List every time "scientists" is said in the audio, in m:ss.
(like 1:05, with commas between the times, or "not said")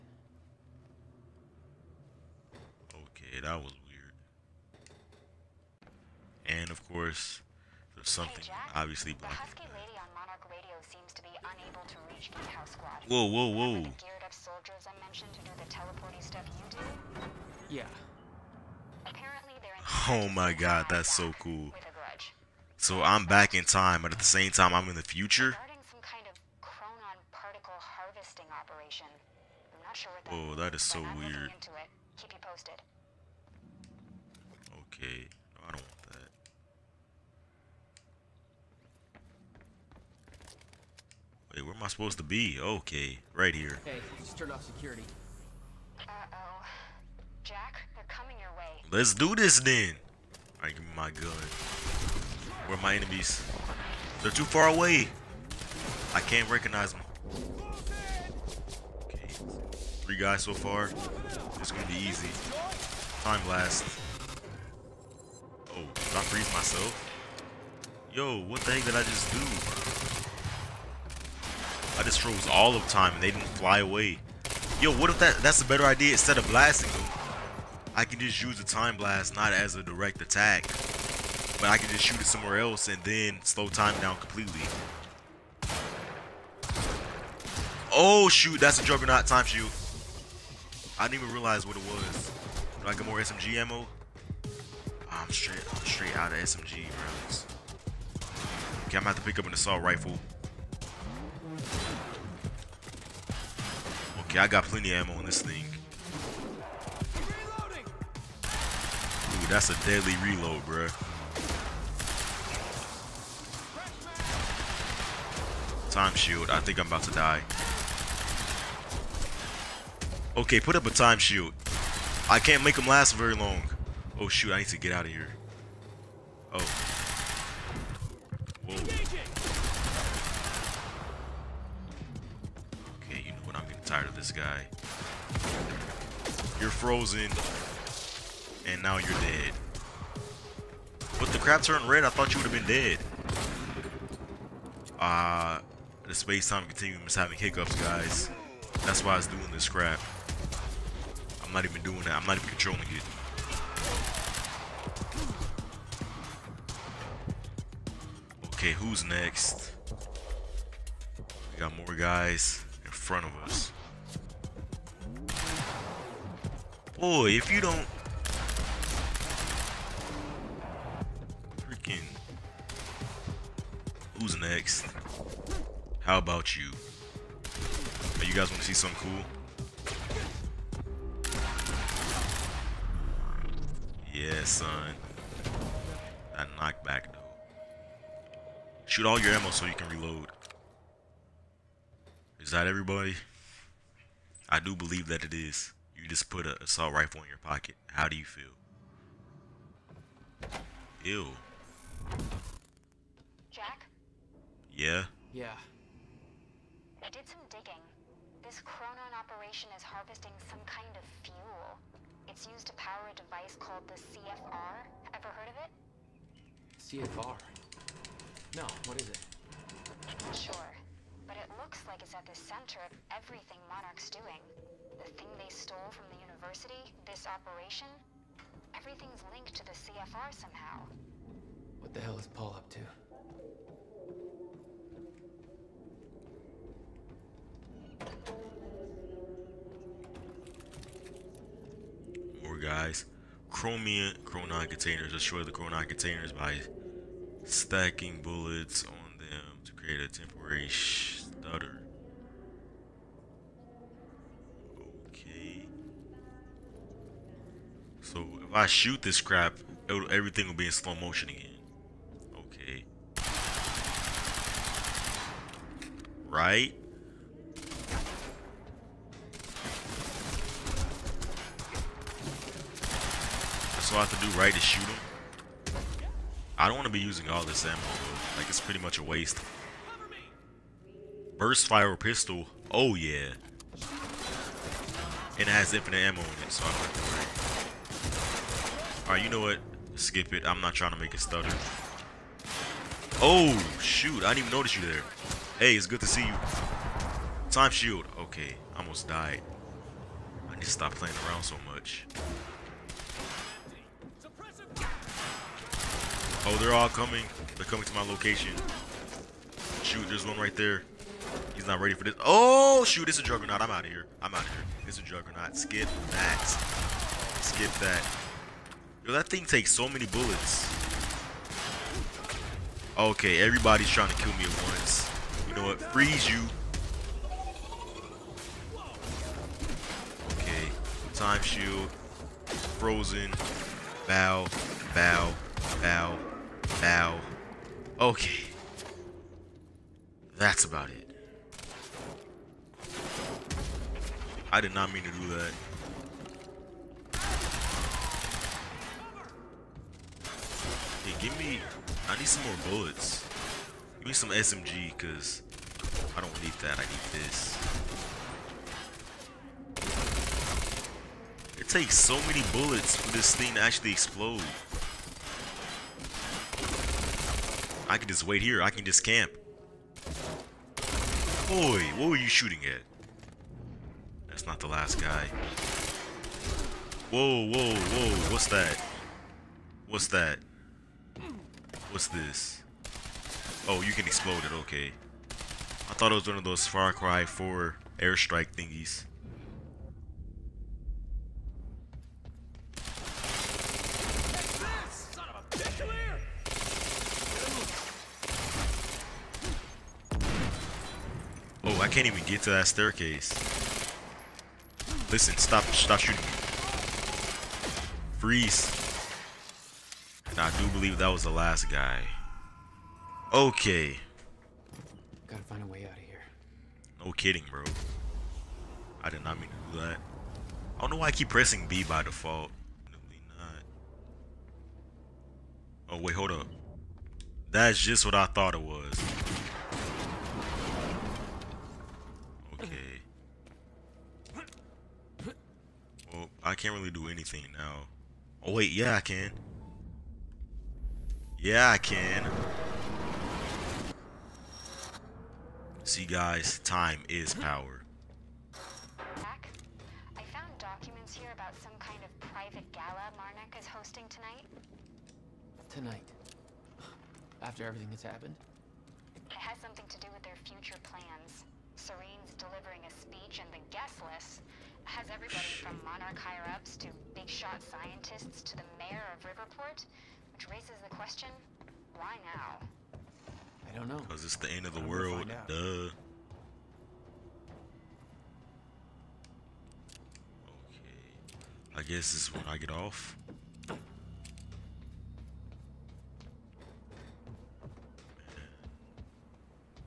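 7:47.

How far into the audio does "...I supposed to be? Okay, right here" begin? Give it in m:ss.
0:41.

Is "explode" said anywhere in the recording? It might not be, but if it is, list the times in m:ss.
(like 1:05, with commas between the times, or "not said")
6:03, 6:24.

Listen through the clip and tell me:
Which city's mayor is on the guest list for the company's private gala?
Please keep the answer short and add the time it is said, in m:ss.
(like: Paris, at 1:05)
Riverport, at 7:49.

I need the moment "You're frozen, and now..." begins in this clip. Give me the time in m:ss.
2:16.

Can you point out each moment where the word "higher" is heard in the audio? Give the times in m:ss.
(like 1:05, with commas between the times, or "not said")
7:46.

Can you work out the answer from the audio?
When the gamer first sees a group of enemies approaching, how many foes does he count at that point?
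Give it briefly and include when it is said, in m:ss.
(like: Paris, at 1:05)
3, at 1:00.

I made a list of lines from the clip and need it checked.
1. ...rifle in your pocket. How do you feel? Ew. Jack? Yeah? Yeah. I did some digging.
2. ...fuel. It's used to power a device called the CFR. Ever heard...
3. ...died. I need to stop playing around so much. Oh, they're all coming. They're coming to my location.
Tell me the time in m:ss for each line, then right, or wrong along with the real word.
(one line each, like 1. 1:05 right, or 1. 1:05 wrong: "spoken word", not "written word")
1. 3:16 right
2. 3:31 right
3. 4:59 right.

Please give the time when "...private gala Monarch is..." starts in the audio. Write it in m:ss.
7:32.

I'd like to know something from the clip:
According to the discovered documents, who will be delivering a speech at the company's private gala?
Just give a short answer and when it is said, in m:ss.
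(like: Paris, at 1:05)
Serene, at 7:41.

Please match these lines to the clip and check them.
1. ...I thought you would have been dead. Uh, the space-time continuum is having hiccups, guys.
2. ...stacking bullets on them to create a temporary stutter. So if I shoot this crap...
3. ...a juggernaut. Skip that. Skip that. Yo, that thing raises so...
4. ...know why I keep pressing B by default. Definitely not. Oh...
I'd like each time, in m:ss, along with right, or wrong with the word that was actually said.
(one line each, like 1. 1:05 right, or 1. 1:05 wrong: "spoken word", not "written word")
1. 2:22 right
2. 4:07 right
3. 5:14 wrong: "takes", not "raises"
4. 7:00 right.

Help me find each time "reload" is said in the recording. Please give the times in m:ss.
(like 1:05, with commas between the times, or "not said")
1:50, 3:09.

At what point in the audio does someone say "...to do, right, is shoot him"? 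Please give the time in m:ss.
4:34.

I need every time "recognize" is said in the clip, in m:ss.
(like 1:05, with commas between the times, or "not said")
0:56.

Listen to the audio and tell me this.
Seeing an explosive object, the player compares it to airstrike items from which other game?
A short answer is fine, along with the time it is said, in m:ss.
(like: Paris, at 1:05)
Far Cry 4, at 6:26.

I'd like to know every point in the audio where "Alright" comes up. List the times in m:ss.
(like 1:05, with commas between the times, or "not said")
0:50, 4:49.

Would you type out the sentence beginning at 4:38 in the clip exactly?
Like, it's pretty much a waste.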